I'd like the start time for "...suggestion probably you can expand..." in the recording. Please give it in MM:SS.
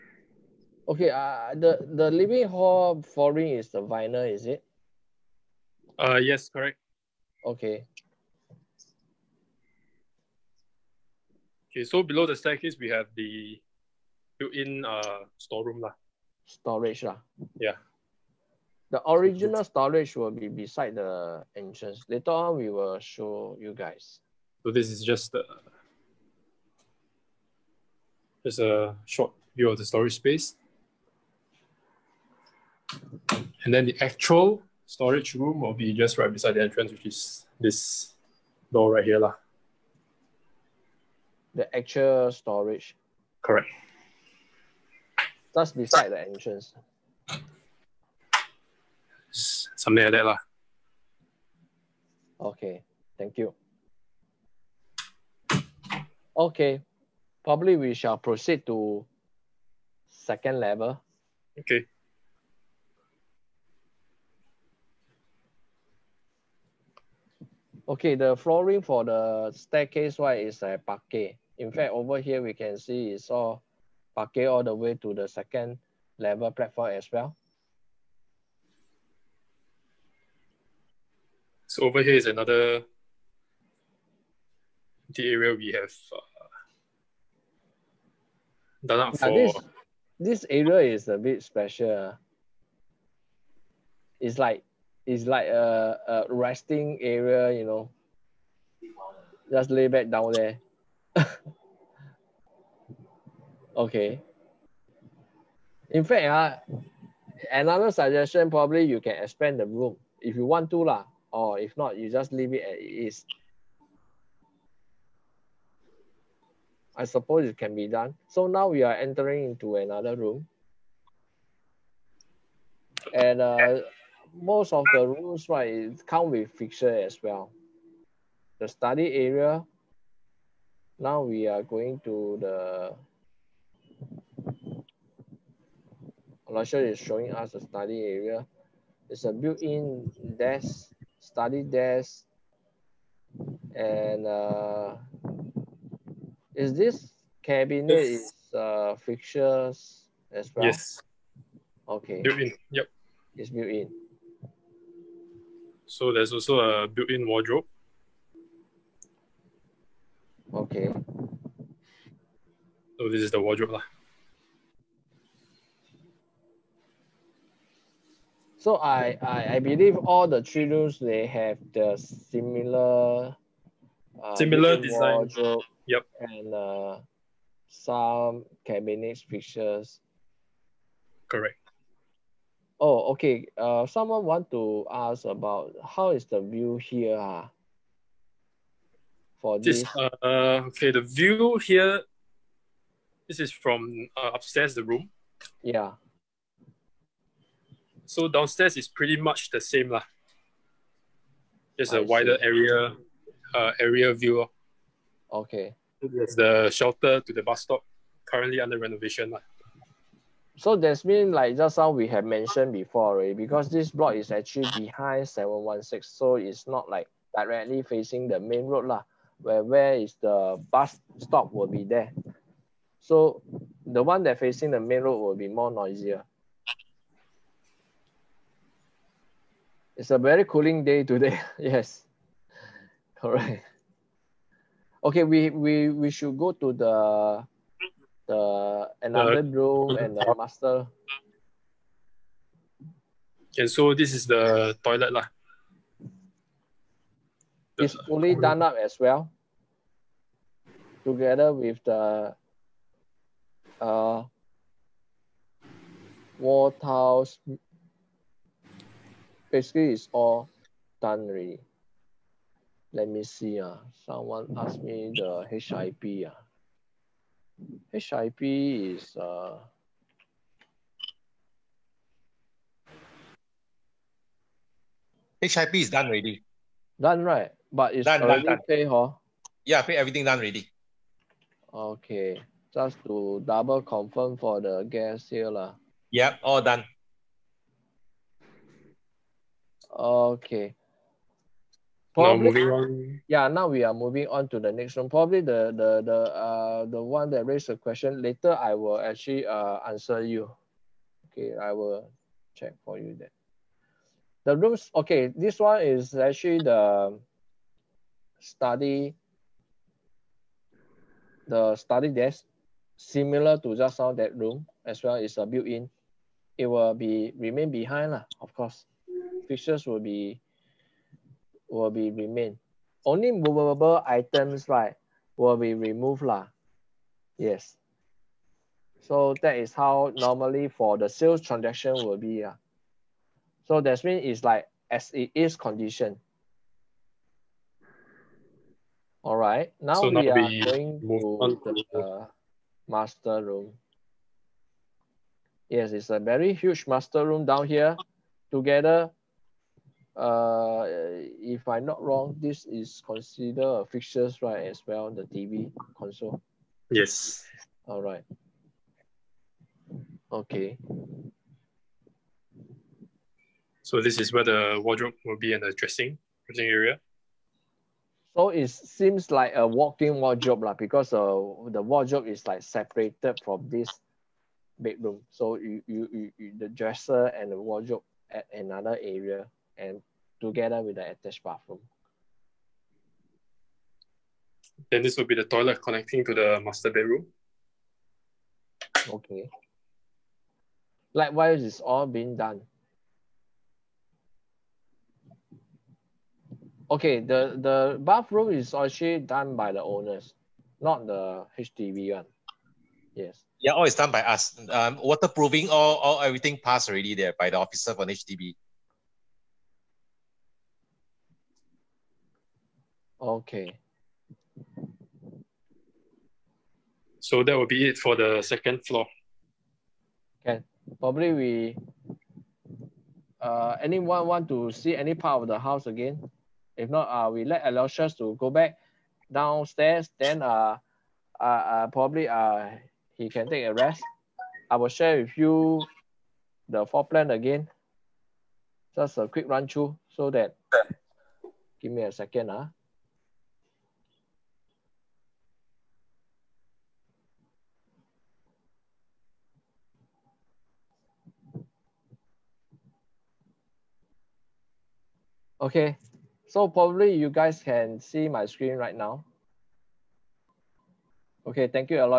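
01:47.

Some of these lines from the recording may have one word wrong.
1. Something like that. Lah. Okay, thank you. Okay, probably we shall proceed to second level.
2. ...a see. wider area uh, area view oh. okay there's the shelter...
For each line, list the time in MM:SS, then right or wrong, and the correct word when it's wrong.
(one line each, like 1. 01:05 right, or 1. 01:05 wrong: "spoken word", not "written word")
1. 00:49 right
2. 03:21 right.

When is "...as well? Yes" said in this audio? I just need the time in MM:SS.
02:30.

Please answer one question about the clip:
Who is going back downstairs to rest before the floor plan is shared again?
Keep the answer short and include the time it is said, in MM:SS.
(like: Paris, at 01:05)
Aloysius, at 07:07.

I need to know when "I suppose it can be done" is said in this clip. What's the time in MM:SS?
01:56.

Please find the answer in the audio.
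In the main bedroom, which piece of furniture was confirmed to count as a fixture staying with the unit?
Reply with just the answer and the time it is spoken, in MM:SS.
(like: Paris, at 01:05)
TV console, at 05:55.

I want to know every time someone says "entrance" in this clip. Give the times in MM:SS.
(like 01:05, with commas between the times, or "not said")
00:21, 00:36, 00:46.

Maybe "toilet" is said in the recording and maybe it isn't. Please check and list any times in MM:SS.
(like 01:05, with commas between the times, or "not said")
04:04, 06:25.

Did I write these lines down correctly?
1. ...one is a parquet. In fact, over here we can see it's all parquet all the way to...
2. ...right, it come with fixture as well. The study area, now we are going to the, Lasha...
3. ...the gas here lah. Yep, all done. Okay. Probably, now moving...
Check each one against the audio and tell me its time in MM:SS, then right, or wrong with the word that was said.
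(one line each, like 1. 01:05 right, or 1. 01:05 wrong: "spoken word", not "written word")
1. 01:10 right
2. 02:05 right
3. 04:44 right.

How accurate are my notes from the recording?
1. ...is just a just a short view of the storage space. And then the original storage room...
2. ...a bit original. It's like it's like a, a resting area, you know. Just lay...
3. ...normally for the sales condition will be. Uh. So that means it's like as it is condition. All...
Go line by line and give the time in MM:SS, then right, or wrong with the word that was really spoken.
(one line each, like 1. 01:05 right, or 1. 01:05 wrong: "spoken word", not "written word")
1. 00:24 wrong: "actual", not "original"
2. 01:31 wrong: "special", not "original"
3. 05:30 wrong: "transaction", not "condition".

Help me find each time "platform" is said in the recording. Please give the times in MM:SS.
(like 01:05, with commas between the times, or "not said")
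01:16.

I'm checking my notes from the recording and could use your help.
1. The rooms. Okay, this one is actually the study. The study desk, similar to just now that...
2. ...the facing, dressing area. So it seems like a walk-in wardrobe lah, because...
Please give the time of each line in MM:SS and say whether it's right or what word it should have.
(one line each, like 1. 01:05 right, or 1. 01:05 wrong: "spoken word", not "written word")
1. 05:04 right
2. 06:05 wrong: "dressing", not "facing".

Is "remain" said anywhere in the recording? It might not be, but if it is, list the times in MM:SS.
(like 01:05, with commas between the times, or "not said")
05:17, 05:22.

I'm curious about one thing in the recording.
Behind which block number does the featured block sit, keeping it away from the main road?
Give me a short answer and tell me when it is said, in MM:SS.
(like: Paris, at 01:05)
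716, at 03:35.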